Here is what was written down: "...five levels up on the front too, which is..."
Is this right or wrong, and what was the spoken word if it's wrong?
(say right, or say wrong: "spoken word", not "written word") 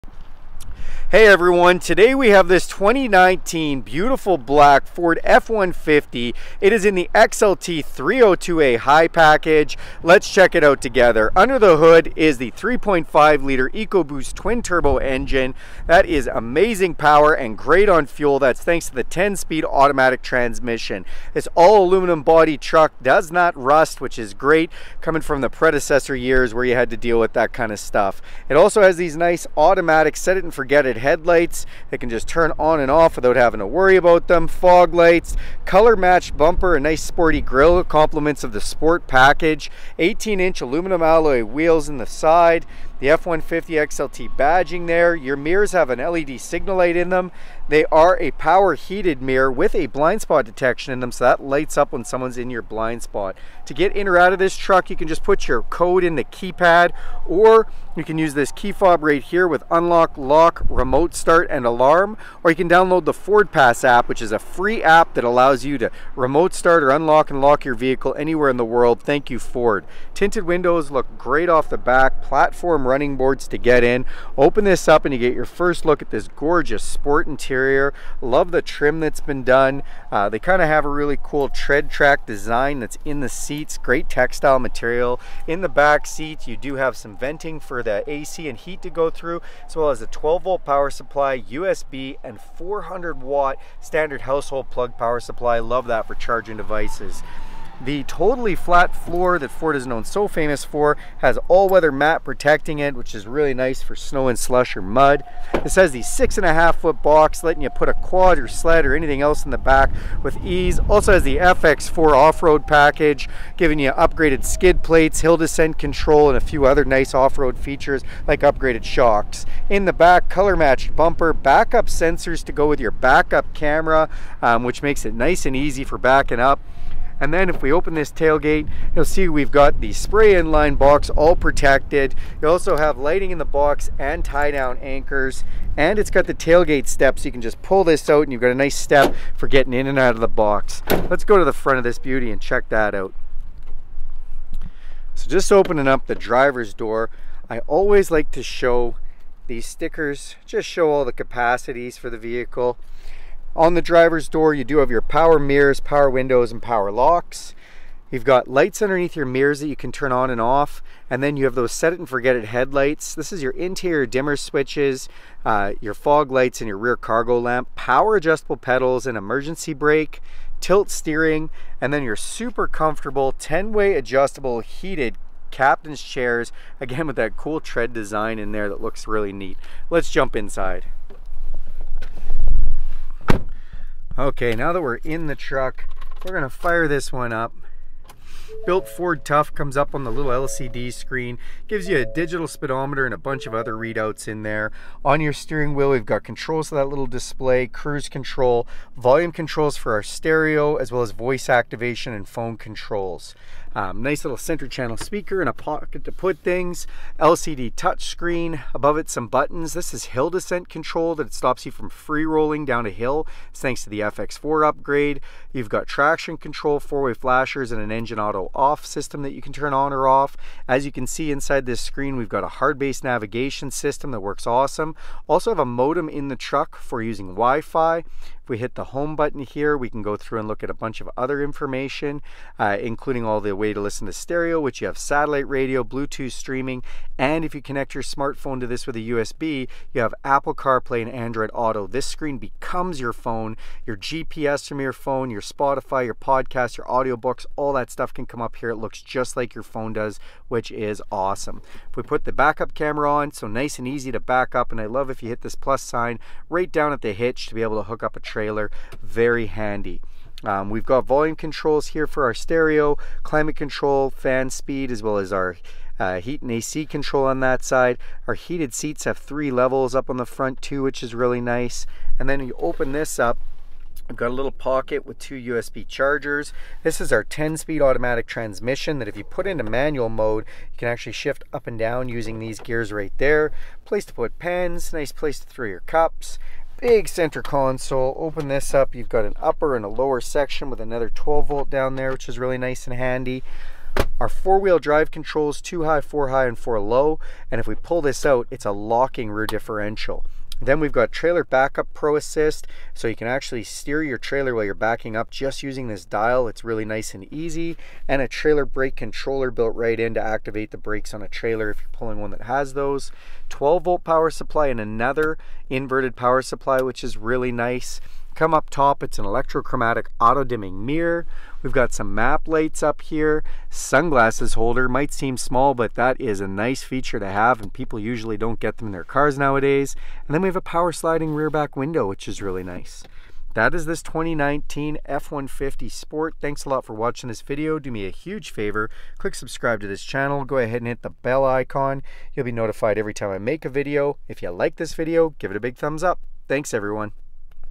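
wrong: "three", not "five".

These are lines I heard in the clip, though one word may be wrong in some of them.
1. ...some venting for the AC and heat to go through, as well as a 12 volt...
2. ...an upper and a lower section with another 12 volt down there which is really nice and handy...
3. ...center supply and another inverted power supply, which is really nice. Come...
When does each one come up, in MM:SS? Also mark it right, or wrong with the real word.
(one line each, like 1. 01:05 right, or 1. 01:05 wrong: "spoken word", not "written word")
1. 01:26 right
2. 04:49 right
3. 05:14 wrong: "power", not "center".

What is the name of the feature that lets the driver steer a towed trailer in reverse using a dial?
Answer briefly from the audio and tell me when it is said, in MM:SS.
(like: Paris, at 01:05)
Trailer Backup Pro Assist, at 05:01.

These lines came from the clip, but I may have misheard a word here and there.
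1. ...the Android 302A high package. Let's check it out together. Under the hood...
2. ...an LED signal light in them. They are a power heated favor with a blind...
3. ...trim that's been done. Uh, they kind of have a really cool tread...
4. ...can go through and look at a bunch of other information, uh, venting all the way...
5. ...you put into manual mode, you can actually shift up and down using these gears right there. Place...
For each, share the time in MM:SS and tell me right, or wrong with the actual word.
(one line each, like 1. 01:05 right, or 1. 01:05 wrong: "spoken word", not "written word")
1. 00:06 wrong: "XLT", not "Android"
2. 00:45 wrong: "mirror", not "favor"
3. 01:18 right
4. 03:49 wrong: "including", not "venting"
5. 04:39 right.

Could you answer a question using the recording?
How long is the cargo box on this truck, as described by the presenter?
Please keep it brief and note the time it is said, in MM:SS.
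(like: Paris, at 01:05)
6.5 feet, at 01:46.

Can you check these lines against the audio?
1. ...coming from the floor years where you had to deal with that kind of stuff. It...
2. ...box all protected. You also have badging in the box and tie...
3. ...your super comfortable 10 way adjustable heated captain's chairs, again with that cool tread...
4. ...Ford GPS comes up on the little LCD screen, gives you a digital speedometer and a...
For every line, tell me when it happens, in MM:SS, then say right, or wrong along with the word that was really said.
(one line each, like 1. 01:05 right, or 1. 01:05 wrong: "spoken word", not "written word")
1. 00:25 wrong: "predecessor", not "floor"
2. 02:10 wrong: "lighting", not "badging"
3. 02:52 right
4. 03:08 wrong: "Tough", not "GPS".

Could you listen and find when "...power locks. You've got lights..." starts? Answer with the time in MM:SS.
02:36.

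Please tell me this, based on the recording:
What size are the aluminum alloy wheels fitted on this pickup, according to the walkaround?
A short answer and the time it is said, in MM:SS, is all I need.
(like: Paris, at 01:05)
18 inch, at 00:39.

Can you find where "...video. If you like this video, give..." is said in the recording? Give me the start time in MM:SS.
05:43.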